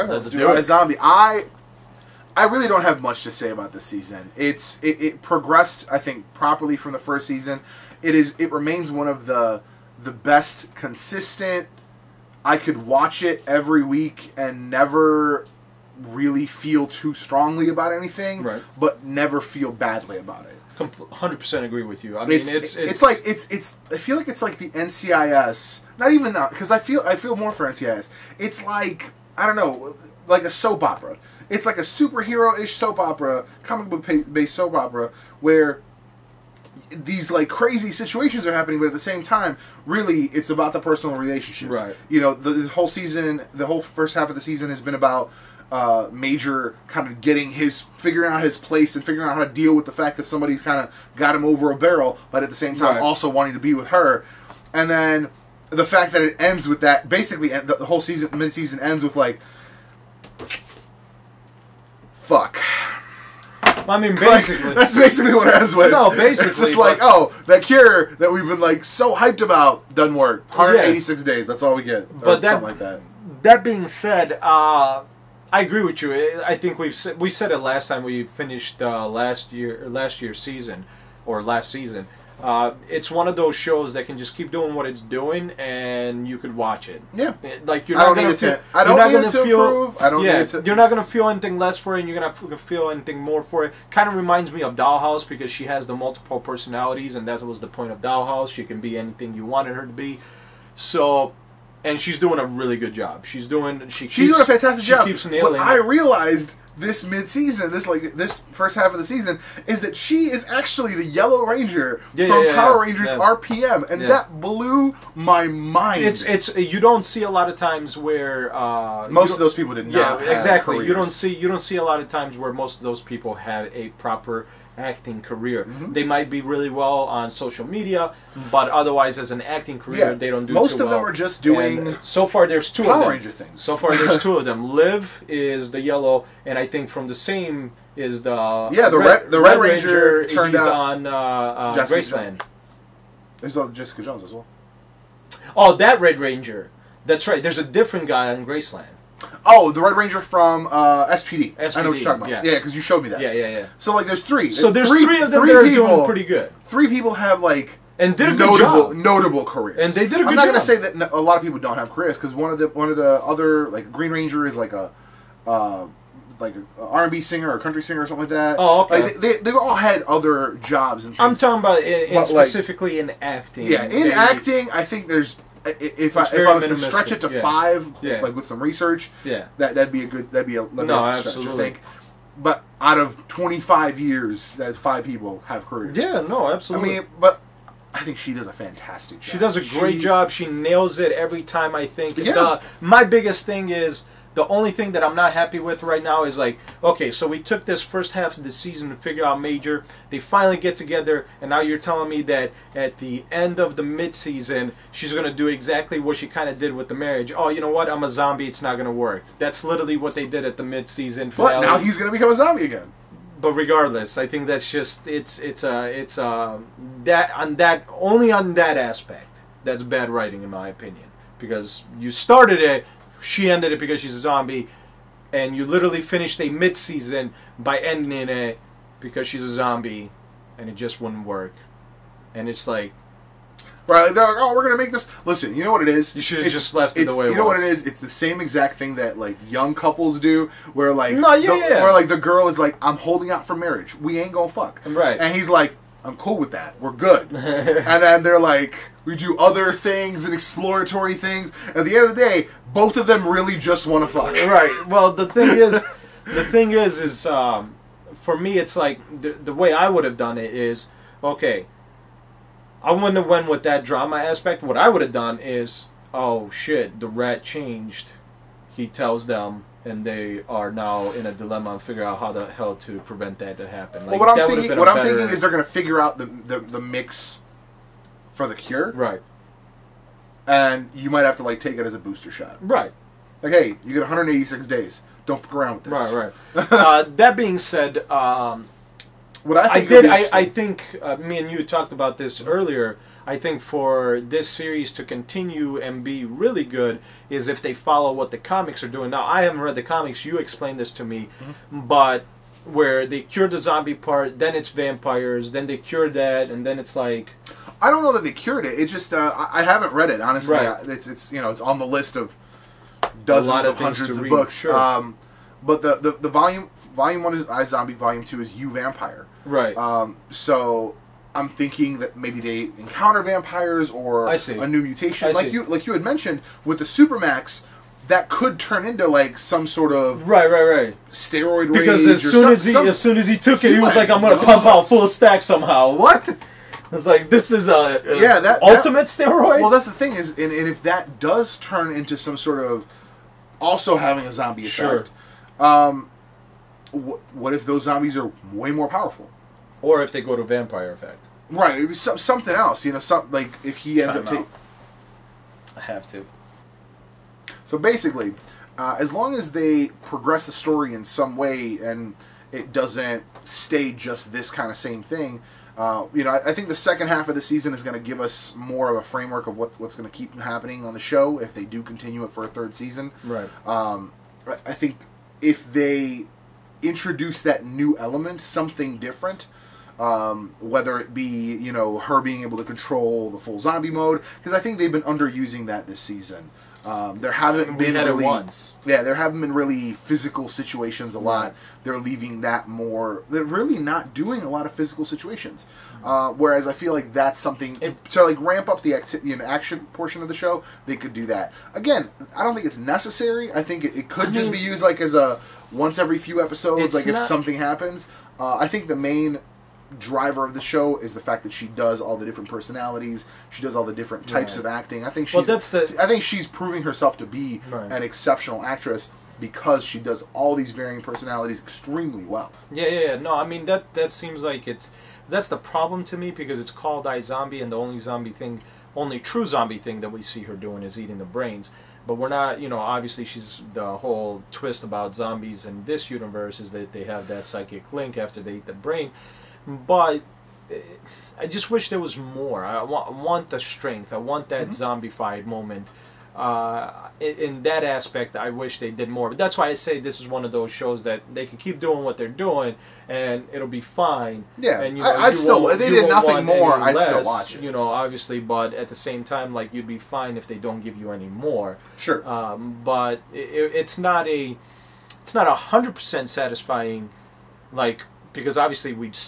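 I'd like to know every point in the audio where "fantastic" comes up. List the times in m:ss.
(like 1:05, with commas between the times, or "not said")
1:44, 3:08.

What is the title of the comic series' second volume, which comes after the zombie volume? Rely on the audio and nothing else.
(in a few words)
You Vampire.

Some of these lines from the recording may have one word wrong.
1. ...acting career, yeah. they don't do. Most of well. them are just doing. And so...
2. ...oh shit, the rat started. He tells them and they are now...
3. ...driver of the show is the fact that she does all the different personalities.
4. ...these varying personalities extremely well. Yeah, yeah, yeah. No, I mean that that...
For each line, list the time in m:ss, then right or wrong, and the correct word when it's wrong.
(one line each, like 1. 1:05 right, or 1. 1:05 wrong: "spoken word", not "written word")
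1. 2:09 right
2. 4:26 wrong: "changed", not "started"
3. 6:49 right
4. 7:00 right.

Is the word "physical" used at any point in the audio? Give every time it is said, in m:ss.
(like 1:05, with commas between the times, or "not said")
6:29, 6:34.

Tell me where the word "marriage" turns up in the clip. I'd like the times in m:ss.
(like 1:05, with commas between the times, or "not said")
3:26, 4:03.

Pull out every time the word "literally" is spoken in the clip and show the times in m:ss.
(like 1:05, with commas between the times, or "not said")
3:29, 3:45.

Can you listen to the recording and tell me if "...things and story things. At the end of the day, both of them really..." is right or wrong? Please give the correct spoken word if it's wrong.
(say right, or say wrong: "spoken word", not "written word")
wrong: "exploratory", not "story".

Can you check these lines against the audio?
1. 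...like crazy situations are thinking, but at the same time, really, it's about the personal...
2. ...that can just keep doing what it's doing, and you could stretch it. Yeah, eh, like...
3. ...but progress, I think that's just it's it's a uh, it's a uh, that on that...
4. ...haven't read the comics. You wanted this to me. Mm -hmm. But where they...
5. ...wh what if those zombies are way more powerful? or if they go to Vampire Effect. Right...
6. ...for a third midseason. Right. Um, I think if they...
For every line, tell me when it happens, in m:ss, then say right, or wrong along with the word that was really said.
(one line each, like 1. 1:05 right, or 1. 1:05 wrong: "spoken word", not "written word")
1. 0:37 wrong: "happening", not "thinking"
2. 1:23 wrong: "watch", not "stretch"
3. 3:33 wrong: "regardless", not "progress"
4. 4:59 wrong: "explained", not "wanted"
5. 5:46 right
6. 6:12 wrong: "season", not "midseason".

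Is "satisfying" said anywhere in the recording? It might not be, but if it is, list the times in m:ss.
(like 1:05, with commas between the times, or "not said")
7:46.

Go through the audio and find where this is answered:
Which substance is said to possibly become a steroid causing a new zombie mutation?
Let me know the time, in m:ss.
5:26.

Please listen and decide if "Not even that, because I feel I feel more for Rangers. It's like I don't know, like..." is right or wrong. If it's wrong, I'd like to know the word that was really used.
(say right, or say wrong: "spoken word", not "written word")
wrong: "NCIS", not "Rangers".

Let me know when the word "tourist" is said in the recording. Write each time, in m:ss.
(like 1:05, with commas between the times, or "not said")
not said.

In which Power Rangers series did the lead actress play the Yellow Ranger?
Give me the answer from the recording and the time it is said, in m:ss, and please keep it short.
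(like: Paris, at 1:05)
Power Rangers RPM, at 1:52.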